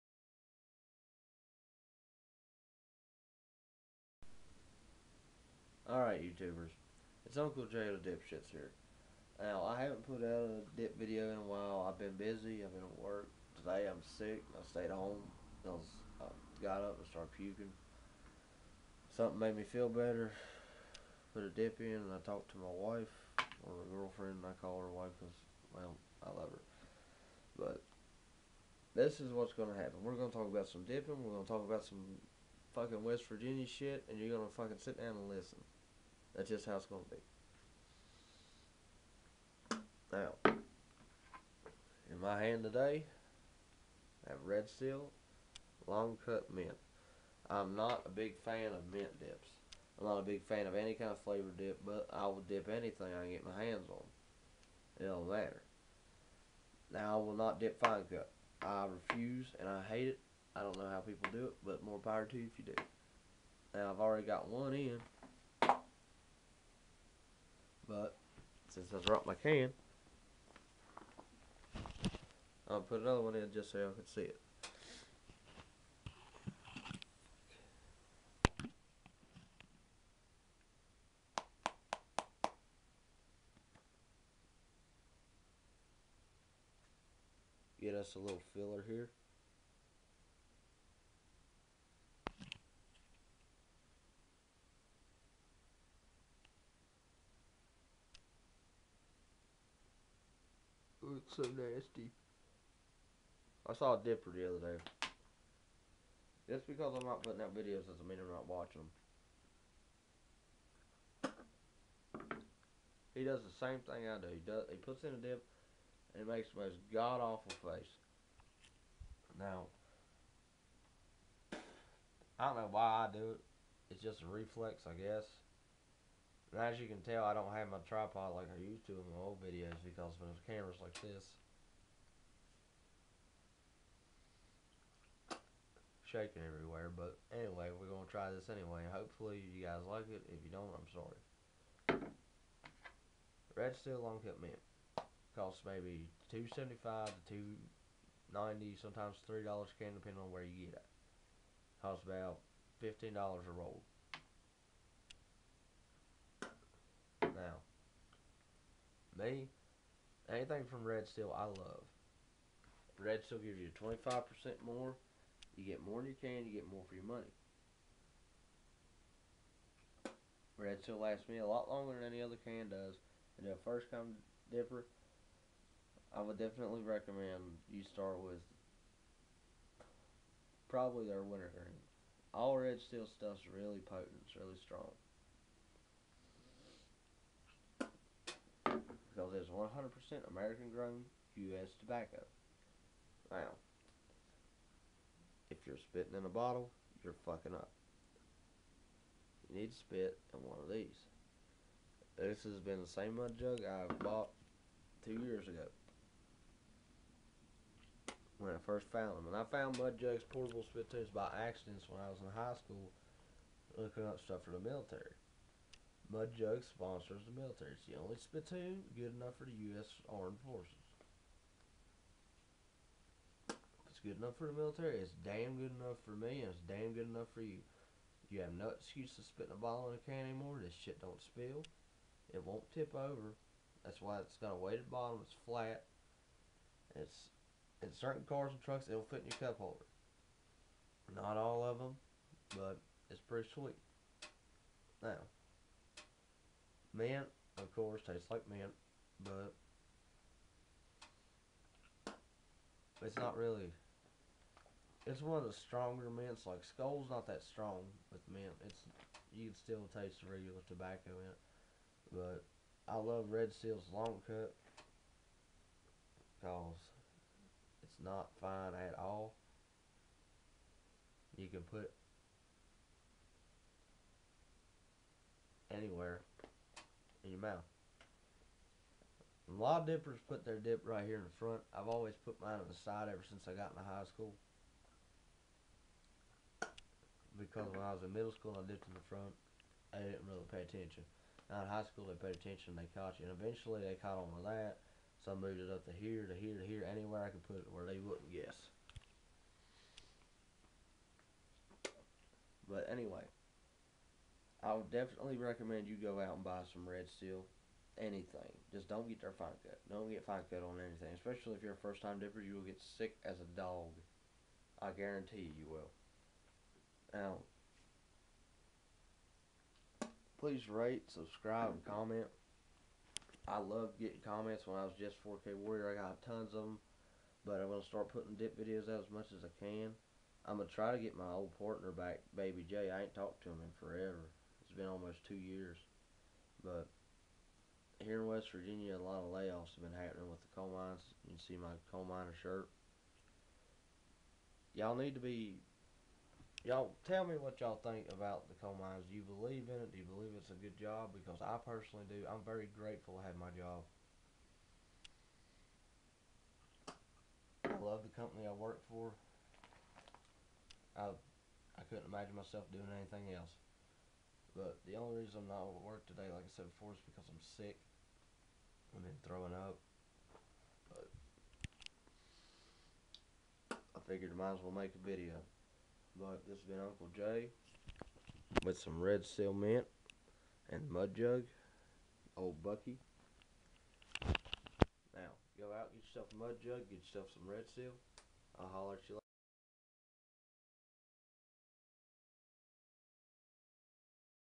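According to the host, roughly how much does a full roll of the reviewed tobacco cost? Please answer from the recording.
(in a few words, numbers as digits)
$15.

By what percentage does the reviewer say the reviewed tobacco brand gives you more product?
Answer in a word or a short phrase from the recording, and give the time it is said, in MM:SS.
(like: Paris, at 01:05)
25%, at 02:43.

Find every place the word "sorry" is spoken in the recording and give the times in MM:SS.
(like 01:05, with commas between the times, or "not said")
02:20.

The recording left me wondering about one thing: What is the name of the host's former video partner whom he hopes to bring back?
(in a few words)
Baby J.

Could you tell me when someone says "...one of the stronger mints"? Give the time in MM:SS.
04:15.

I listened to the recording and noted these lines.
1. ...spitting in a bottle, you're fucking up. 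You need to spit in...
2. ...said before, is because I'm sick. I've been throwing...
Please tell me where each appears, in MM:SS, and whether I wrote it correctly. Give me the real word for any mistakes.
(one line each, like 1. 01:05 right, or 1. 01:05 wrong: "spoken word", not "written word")
1. 03:15 right
2. 06:06 right.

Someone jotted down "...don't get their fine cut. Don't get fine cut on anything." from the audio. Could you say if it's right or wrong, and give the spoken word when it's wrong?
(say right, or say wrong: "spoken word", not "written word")
right.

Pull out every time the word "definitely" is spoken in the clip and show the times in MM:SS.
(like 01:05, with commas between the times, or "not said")
02:56, 05:04.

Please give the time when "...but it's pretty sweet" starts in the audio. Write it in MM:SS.
04:02.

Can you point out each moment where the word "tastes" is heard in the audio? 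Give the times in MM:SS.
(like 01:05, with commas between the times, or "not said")
04:08, 04:19.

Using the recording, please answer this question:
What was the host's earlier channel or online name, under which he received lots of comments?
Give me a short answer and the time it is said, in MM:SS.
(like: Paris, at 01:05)
Jess 4K Warrior, at 05:24.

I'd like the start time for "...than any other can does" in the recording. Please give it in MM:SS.
02:51.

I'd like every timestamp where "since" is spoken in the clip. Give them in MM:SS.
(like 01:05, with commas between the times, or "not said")
01:08, 04:43.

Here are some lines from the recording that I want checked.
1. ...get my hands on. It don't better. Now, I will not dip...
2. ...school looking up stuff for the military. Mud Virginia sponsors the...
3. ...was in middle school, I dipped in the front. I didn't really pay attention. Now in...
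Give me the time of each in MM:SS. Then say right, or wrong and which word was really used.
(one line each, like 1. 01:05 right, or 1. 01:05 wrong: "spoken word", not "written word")
1. 00:53 wrong: "matter", not "better"
2. 03:32 wrong: "Jug", not "Virginia"
3. 04:47 right.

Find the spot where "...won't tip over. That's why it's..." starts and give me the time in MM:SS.
03:52.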